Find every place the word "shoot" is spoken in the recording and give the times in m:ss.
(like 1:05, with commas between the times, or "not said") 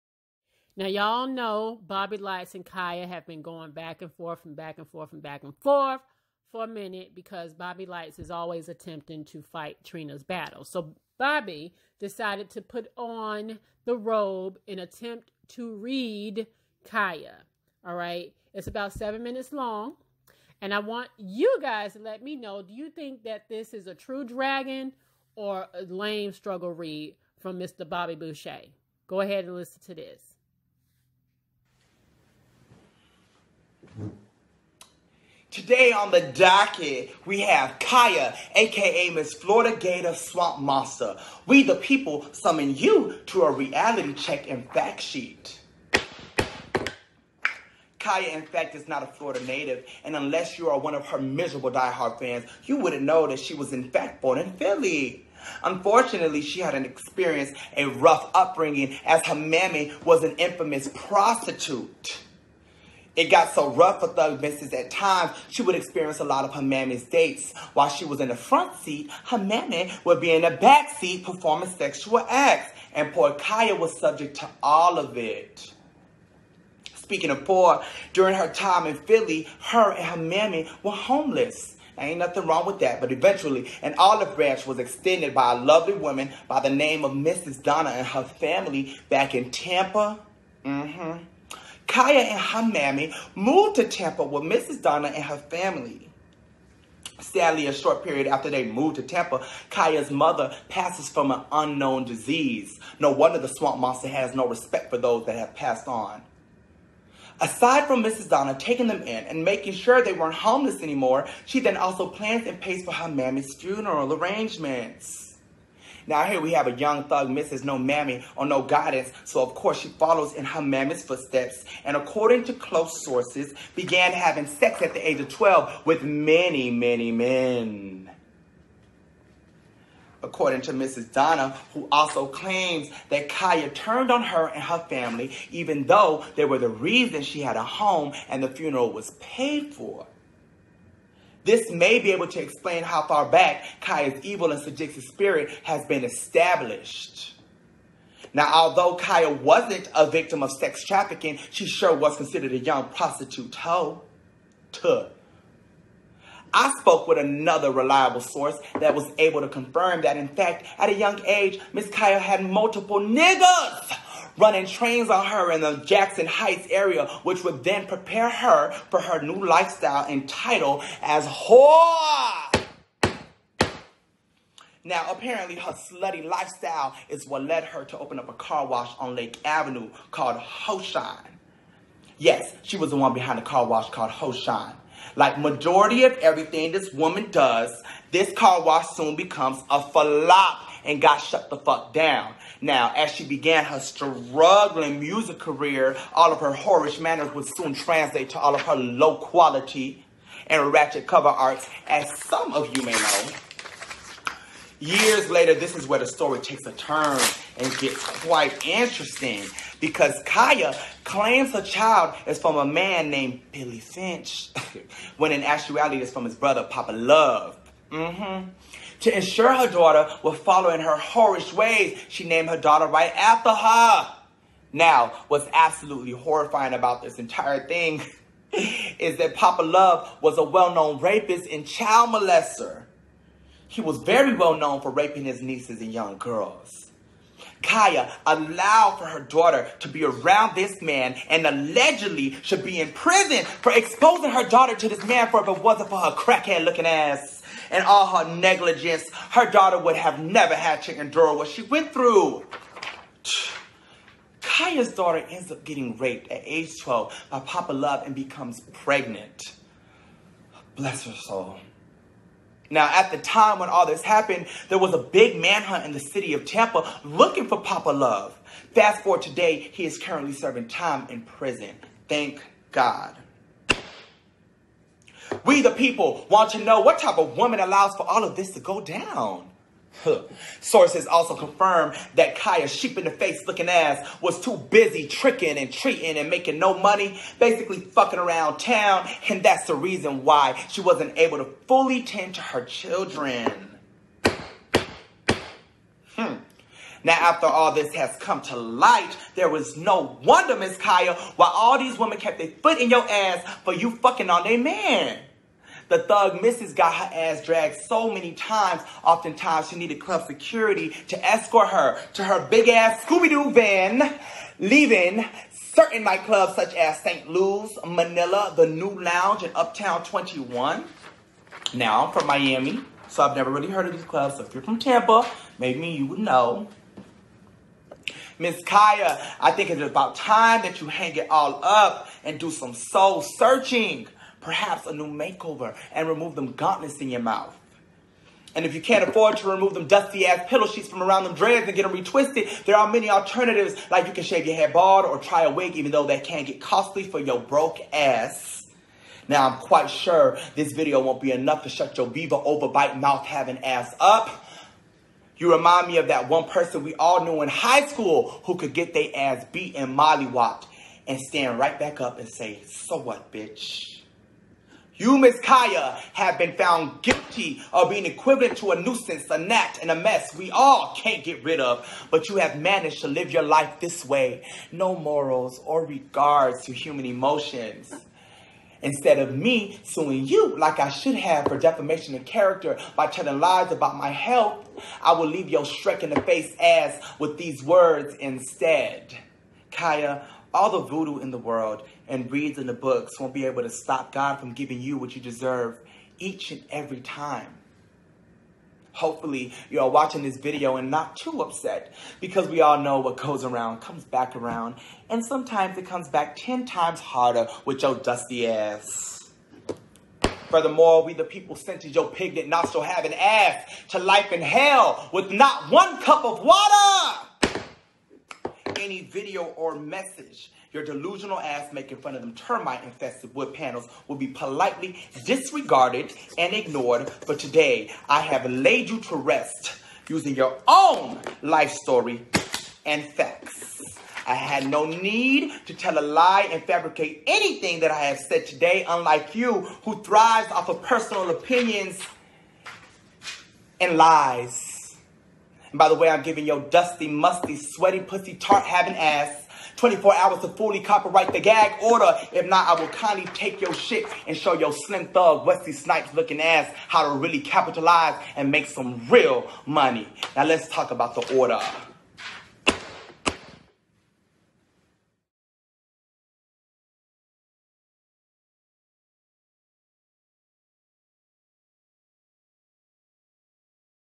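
not said.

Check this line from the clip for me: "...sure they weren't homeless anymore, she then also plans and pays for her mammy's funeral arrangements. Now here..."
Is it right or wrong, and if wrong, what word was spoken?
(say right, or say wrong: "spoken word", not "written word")
right.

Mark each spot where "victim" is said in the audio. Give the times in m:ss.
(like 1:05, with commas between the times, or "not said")
2:30.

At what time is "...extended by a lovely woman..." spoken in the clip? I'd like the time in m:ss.
1:24.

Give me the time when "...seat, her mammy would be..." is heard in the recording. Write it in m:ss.
1:08.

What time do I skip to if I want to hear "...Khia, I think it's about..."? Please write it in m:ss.
5:28.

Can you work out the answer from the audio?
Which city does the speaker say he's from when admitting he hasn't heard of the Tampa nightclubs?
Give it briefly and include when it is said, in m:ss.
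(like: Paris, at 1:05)
Miami, at 5:22.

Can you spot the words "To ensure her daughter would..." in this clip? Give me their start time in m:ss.
3:39.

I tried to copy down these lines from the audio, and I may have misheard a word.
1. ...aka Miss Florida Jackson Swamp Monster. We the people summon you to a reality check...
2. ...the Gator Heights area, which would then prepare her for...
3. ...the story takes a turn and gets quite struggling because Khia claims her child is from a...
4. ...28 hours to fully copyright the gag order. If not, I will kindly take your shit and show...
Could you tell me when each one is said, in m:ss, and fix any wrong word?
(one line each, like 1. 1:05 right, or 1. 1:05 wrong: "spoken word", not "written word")
1. 0:38 wrong: "Gator", not "Jackson"
2. 2:45 wrong: "Jackson", not "Gator"
3. 3:25 wrong: "interesting", not "struggling"
4. 7:29 wrong: "24", not "28".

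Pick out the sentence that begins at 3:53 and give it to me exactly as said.
He was very well known for raping his nieces and young girls.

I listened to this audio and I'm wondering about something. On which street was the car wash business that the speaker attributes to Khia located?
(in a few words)
Lake Avenue.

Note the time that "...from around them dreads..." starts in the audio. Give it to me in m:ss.
5:40.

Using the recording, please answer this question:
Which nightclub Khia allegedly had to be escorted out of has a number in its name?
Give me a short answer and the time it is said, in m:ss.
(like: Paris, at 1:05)
Uptown 21, at 5:19.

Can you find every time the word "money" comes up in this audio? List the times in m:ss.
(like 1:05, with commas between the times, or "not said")
4:46, 7:39.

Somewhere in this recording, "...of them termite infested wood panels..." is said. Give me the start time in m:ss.
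7:02.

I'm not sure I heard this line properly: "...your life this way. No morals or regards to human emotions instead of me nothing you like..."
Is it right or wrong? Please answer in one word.
wrong.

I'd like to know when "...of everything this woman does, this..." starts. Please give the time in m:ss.
3:06.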